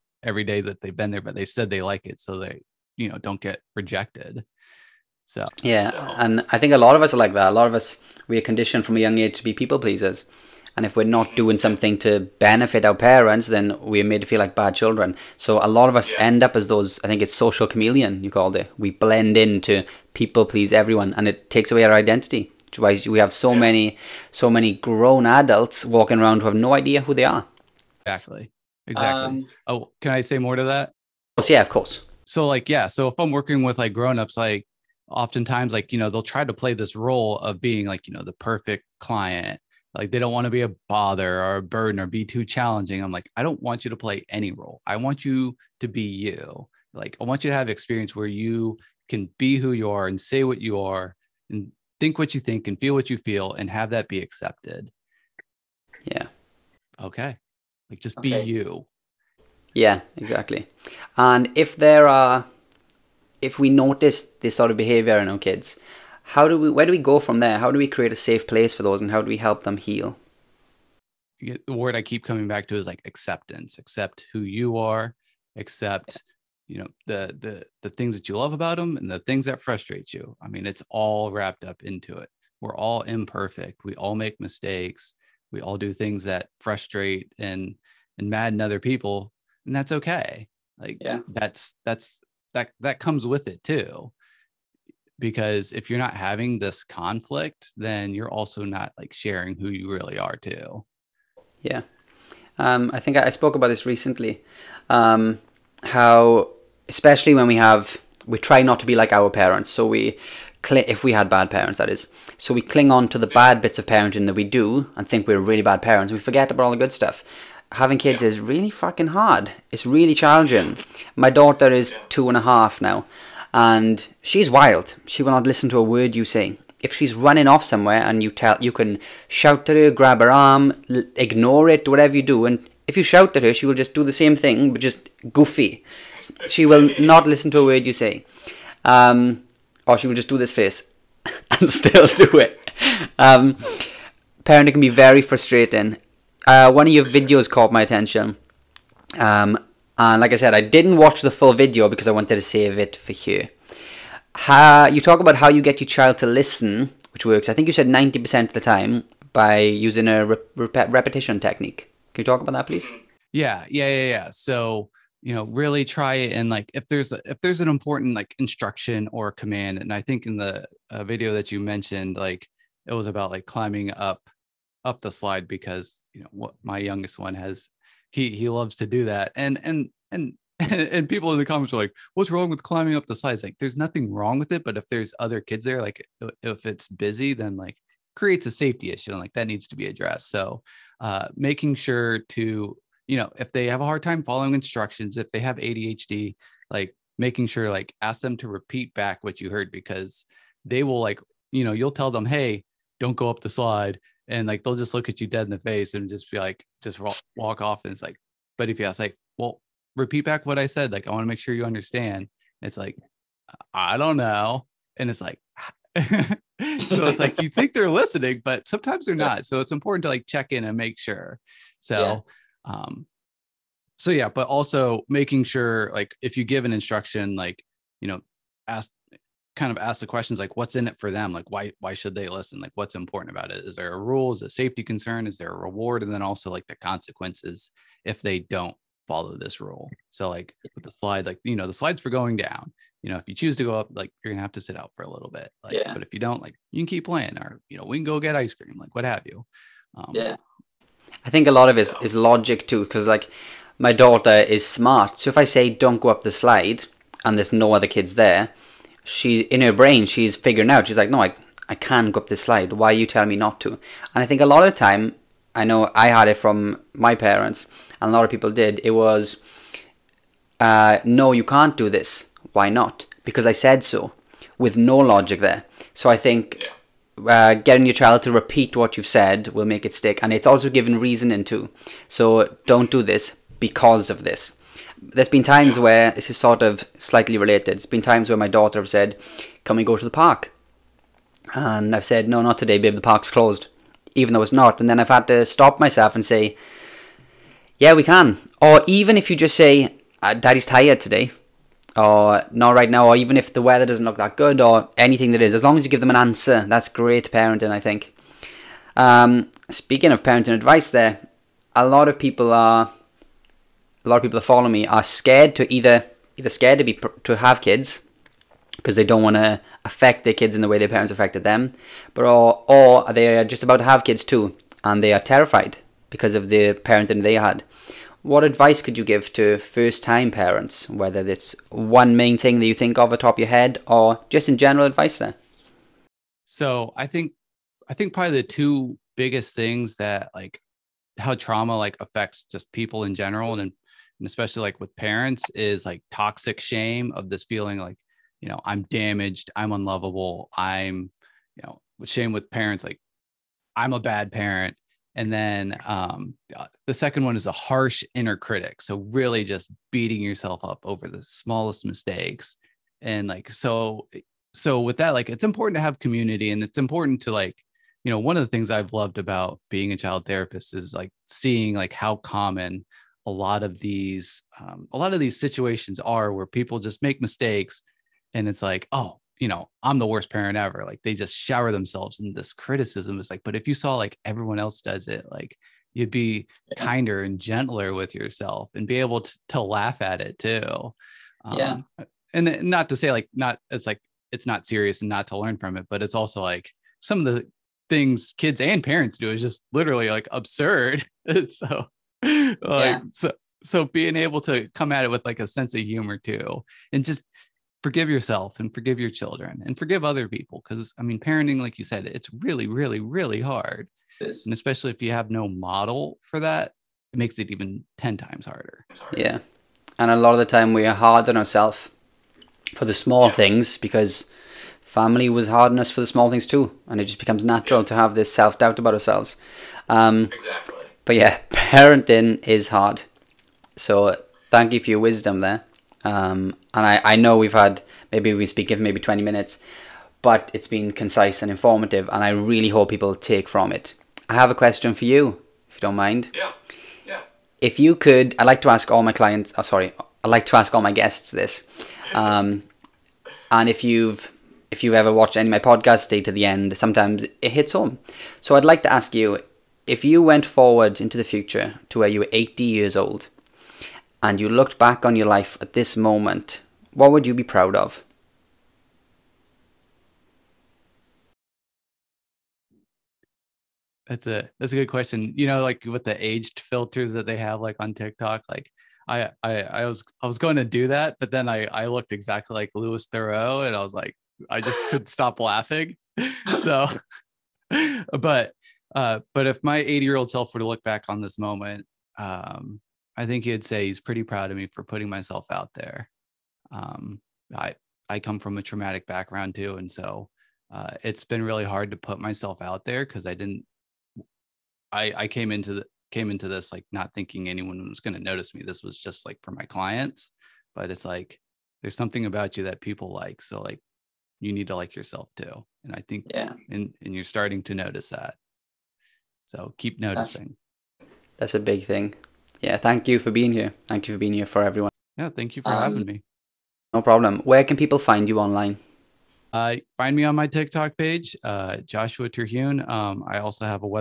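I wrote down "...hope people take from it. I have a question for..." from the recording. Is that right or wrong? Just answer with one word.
right.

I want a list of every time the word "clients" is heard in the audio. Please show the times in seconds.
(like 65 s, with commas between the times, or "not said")
38 s, 449 s, 509 s.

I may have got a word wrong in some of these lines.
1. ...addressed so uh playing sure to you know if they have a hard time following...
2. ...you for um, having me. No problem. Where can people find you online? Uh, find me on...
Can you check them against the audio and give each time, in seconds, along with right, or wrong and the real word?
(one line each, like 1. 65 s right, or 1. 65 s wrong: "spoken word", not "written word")
1. 189 s wrong: "making", not "playing"
2. 525 s right.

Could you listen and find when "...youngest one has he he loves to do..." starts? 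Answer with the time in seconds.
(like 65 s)
176 s.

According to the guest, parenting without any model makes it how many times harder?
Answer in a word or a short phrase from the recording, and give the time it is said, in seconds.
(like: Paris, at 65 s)
10 times, at 417 s.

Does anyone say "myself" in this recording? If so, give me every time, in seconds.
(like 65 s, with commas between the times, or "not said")
295 s, 495 s, 502 s.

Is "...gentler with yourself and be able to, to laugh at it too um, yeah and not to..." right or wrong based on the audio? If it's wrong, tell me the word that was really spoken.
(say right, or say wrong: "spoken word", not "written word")
right.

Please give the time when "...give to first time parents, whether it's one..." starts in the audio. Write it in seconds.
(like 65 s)
329 s.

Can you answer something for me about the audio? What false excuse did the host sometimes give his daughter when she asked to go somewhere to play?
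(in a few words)
The park's closed.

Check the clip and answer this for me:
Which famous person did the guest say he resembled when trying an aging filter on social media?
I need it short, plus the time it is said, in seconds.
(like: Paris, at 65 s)
Louis Theroux, at 482 s.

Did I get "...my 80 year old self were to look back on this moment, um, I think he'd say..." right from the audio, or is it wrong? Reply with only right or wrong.
right.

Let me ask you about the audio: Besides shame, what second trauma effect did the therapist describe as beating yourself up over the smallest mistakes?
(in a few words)
harsh inner critic.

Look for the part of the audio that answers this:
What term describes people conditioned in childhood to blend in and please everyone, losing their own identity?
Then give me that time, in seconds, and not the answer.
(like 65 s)
17 s.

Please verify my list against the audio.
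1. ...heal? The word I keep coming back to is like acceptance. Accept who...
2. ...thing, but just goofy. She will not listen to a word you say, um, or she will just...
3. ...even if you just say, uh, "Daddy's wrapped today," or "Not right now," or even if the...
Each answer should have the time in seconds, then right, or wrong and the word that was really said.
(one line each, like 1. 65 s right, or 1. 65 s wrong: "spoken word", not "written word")
1. 69 s right
2. 134 s right
3. 298 s wrong: "tired", not "wrapped".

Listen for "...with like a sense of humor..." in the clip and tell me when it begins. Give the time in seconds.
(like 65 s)
405 s.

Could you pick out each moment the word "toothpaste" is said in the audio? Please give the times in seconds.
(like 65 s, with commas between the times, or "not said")
not said.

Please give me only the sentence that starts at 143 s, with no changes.
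Um, parenting can be very frustrating uh, one of your videos caught my attention.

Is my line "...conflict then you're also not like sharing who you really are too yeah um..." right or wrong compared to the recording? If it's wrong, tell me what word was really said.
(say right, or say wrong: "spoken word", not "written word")
right.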